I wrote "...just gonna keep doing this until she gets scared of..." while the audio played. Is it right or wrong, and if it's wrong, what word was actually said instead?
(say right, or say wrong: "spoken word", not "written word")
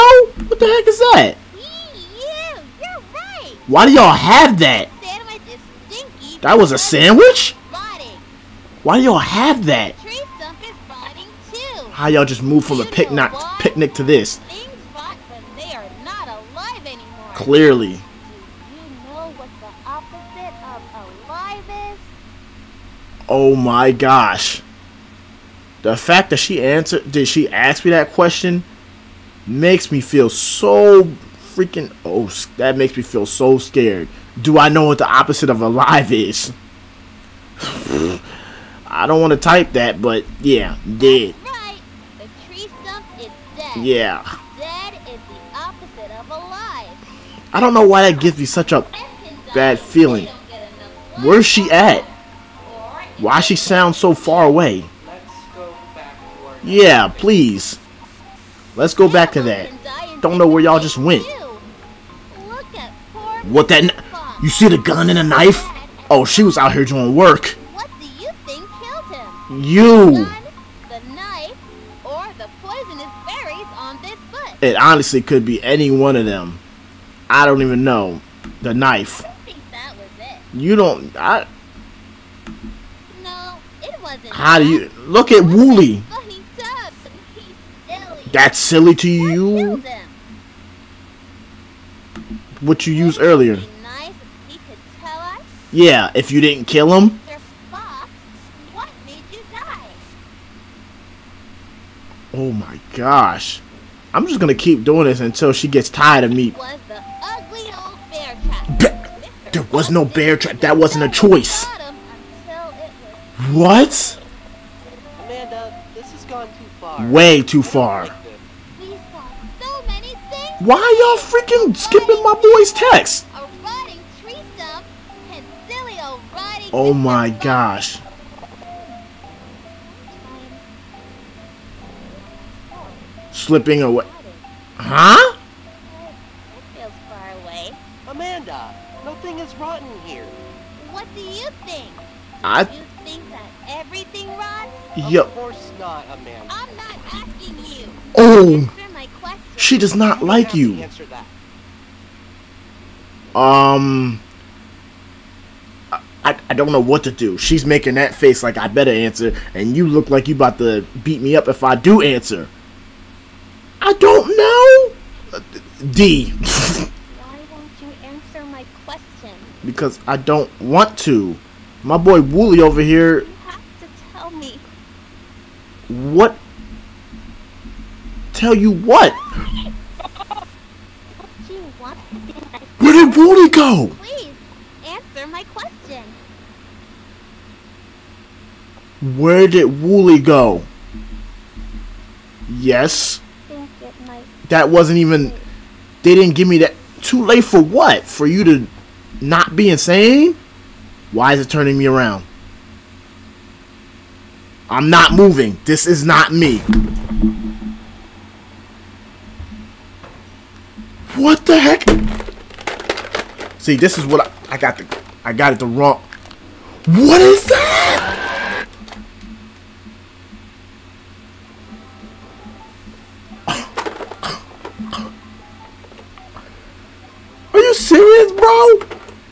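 wrong: "tired", not "scared".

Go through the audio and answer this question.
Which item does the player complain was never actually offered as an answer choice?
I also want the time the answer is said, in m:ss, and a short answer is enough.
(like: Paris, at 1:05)
bear trap, at 1:50.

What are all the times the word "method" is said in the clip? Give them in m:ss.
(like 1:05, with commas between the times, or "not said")
not said.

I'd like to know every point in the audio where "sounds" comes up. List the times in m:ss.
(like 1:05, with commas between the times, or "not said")
0:53.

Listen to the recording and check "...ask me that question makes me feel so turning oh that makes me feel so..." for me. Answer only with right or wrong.
wrong.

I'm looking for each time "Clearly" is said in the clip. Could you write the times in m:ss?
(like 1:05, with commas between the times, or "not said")
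0:17.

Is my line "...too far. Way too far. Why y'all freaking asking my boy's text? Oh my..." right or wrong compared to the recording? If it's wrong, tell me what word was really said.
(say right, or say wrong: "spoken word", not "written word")
wrong: "skipping", not "asking".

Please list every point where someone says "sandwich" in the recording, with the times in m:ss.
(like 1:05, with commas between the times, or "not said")
0:06.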